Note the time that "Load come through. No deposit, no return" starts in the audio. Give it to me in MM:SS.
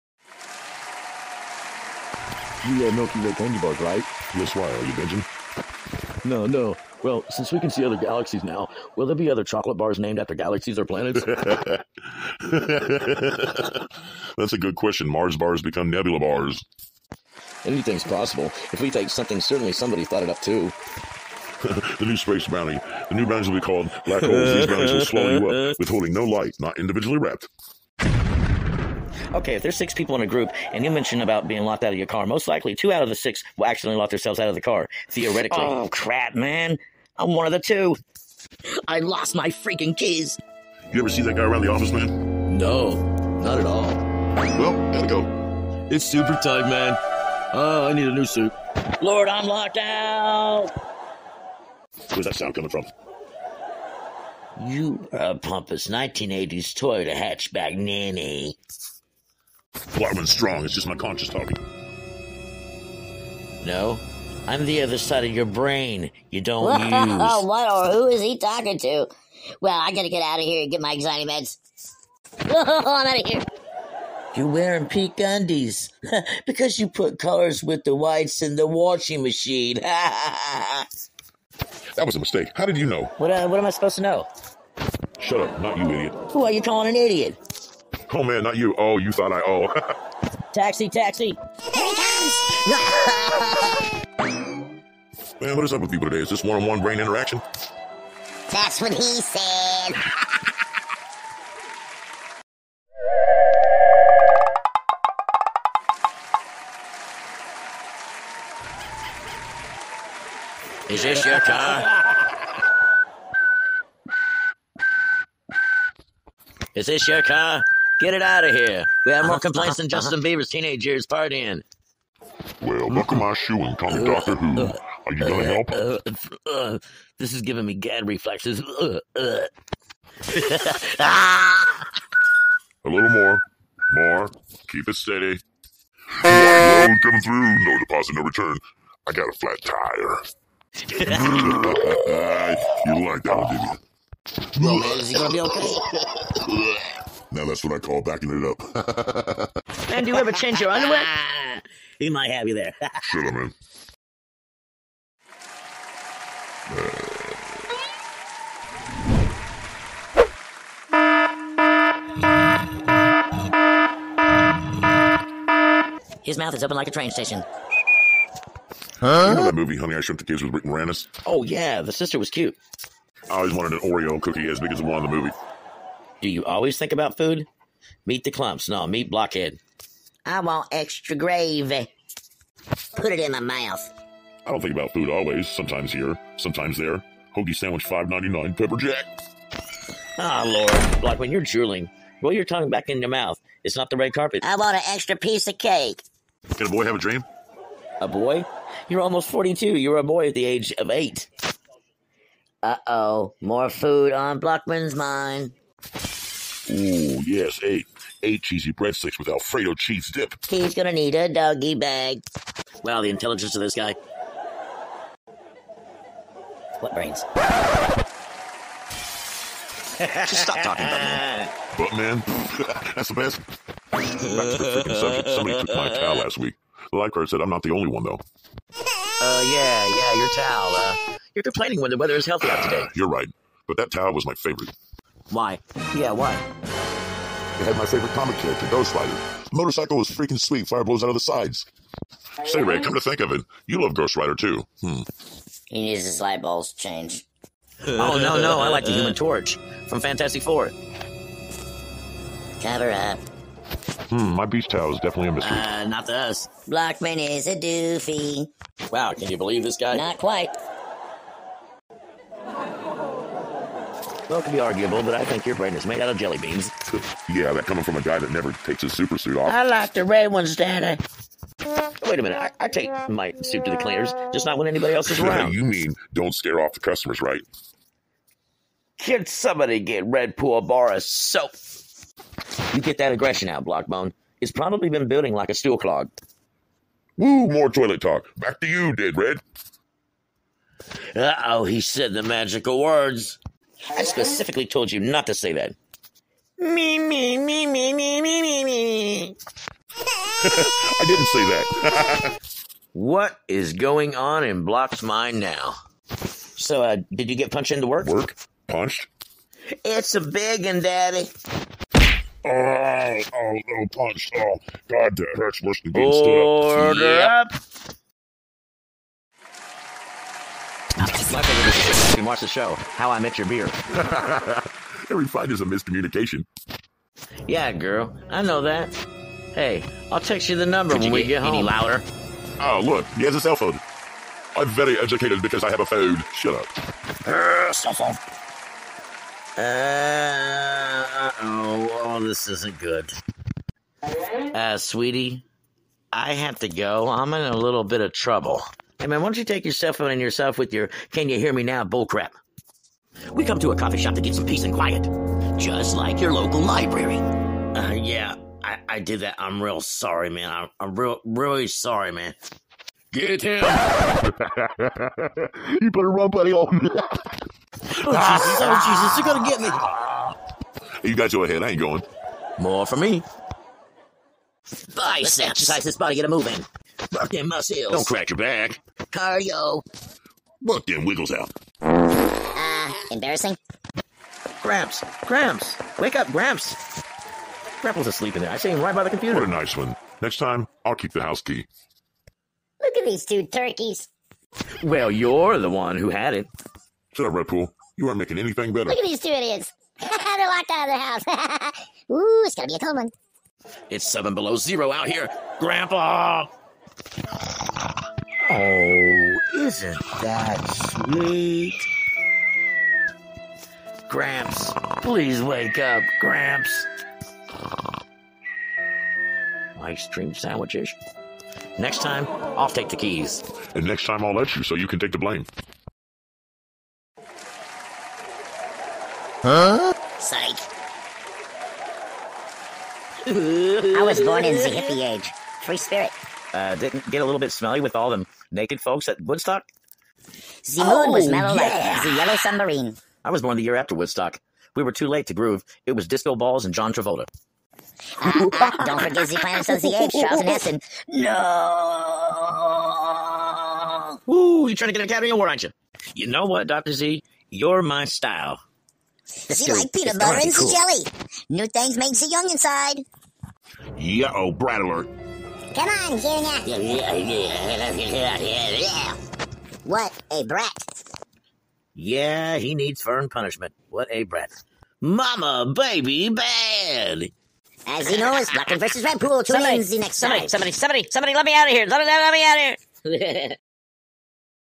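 02:16.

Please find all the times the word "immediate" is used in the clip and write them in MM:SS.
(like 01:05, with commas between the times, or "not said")
not said.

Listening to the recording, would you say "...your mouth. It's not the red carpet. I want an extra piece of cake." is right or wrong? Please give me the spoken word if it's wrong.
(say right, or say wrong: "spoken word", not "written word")
right.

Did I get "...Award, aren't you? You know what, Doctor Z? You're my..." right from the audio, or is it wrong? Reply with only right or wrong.
right.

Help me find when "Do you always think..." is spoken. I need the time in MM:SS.
02:56.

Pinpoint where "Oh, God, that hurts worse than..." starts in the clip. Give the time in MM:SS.
05:14.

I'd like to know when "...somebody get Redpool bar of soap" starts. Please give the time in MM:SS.
04:39.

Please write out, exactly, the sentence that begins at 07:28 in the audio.
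Uh, uh, don't forget the Planets of the Apes, Charles No.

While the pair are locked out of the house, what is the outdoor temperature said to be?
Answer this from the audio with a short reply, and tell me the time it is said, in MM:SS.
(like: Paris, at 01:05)
7 below zero, at 06:44.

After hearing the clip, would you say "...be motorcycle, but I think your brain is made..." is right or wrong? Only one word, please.
wrong.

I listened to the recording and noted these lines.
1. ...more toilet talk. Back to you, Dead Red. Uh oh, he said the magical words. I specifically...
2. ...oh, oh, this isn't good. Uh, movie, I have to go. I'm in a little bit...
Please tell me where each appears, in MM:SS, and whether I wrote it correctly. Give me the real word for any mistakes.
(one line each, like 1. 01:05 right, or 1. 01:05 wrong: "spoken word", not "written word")
1. 04:47 right
2. 05:41 wrong: "sweetie", not "movie".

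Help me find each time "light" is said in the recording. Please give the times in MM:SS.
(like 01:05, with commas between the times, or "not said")
00:26, 04:06.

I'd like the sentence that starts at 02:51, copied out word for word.
Oh, yeah, the sister was cute.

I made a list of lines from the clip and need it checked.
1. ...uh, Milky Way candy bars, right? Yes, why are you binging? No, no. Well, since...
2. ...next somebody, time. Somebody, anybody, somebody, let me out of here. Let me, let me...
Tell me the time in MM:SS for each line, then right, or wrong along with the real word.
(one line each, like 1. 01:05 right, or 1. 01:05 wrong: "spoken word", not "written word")
1. 00:02 right
2. 07:59 wrong: "somebody", not "anybody".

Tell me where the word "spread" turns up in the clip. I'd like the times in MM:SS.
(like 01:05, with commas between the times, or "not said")
not said.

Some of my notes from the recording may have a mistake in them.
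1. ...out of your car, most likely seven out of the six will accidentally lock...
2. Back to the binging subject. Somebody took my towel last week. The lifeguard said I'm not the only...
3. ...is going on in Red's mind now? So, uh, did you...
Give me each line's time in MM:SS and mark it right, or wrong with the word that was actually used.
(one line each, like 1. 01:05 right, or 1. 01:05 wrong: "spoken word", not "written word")
1. 00:31 wrong: "two", not "seven"
2. 03:43 wrong: "freaking", not "binging"
3. 05:03 wrong: "Block", not "Red".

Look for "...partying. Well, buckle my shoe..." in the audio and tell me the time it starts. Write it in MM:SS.
02:01.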